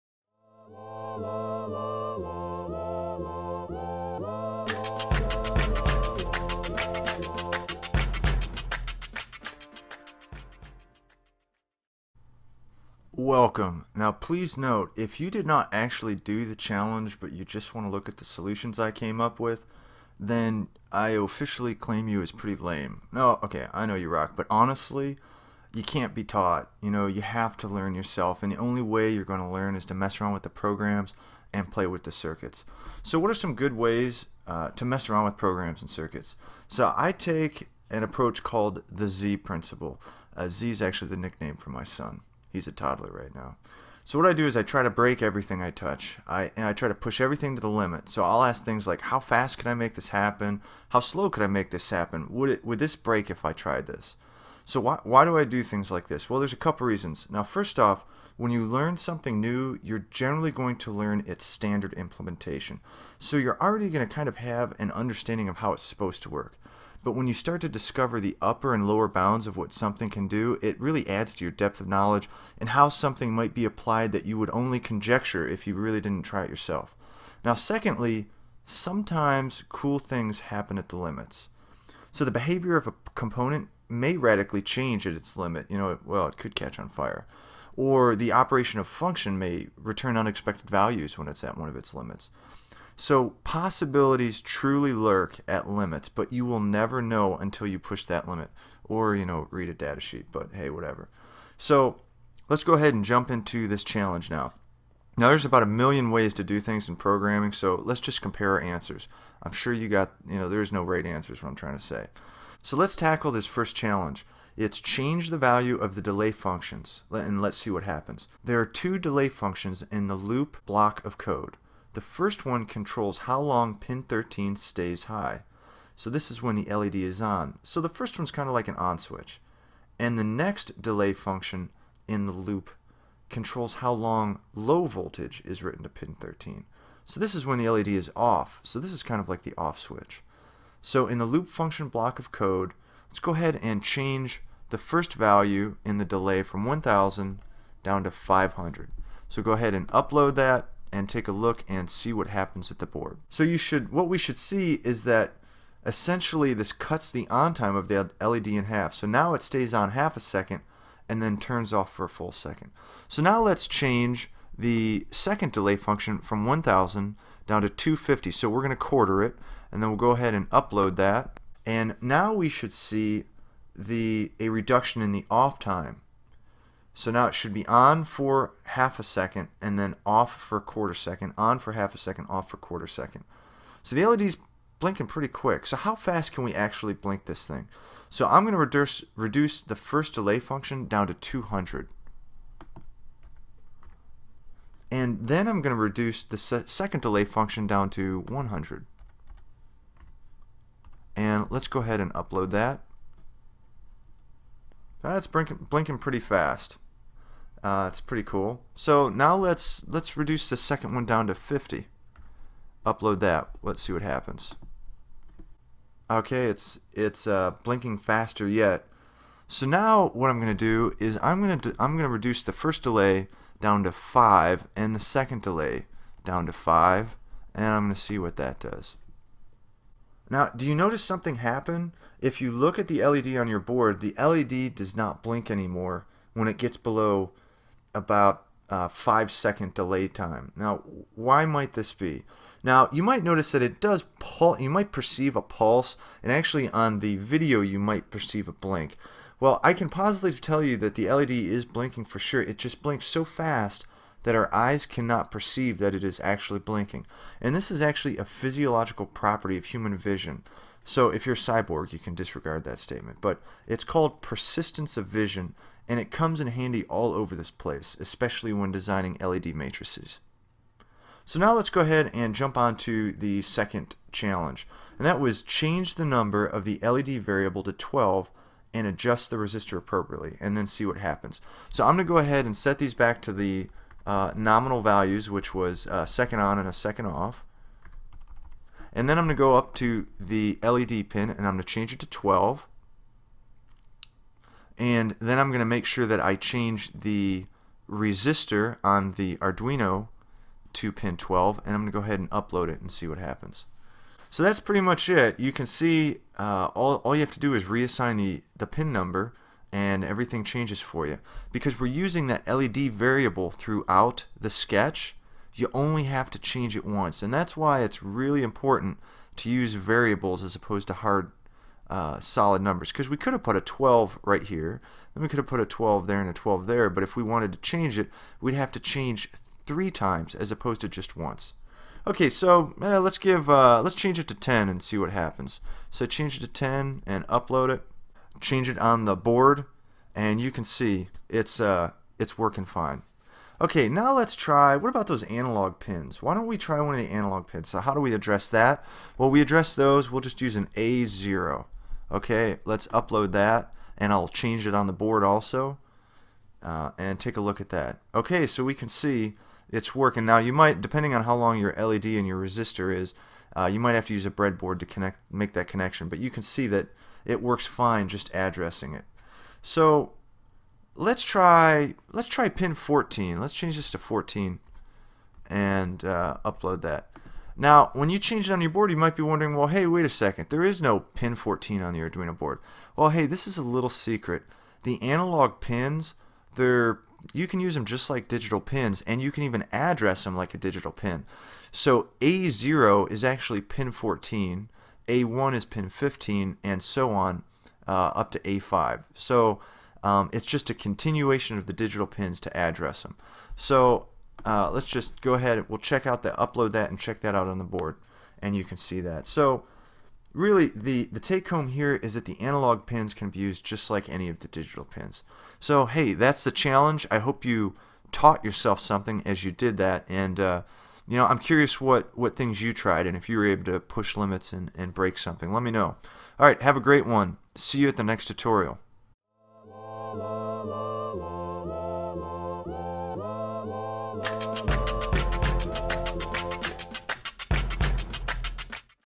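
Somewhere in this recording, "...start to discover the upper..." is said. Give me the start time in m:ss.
1:07.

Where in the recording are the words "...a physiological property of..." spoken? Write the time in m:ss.
4:18.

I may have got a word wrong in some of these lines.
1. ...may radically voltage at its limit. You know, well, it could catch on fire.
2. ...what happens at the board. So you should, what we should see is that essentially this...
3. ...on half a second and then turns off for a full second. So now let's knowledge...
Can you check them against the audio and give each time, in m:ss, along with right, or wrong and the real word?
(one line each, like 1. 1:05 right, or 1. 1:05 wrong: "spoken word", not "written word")
1. 1:23 wrong: "change", not "voltage"
2. 2:32 right
3. 2:39 wrong: "change", not "knowledge".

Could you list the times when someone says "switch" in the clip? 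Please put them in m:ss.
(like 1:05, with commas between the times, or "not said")
2:08, 2:19.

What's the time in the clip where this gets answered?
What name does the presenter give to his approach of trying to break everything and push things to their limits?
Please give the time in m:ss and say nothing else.
0:39.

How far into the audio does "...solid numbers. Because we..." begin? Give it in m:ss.
5:22.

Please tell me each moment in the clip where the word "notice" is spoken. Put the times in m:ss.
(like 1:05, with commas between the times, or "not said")
3:50, 4:03.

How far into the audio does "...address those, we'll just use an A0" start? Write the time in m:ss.
5:49.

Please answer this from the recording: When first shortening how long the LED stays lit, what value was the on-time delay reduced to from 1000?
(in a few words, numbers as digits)
500.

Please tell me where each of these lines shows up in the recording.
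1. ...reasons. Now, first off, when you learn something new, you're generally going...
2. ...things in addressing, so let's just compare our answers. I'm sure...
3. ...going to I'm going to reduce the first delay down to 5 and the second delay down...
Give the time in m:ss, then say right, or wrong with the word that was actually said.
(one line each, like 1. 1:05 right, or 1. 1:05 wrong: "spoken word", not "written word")
1. 0:56 right
2. 1:46 wrong: "programming", not "addressing"
3. 3:41 right.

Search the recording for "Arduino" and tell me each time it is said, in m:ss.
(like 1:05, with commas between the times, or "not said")
4:59, 6:21.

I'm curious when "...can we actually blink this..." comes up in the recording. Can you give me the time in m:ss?
3:06.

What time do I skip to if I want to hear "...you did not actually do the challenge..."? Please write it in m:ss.
0:15.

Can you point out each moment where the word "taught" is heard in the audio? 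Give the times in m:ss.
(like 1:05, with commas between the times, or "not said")
0:26, 6:58.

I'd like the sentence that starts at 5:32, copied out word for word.
Okay, so eh, let's give uh, let's change it to 10 and see what happens.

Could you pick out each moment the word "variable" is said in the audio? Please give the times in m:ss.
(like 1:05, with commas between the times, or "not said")
4:37, 5:12, 5:19.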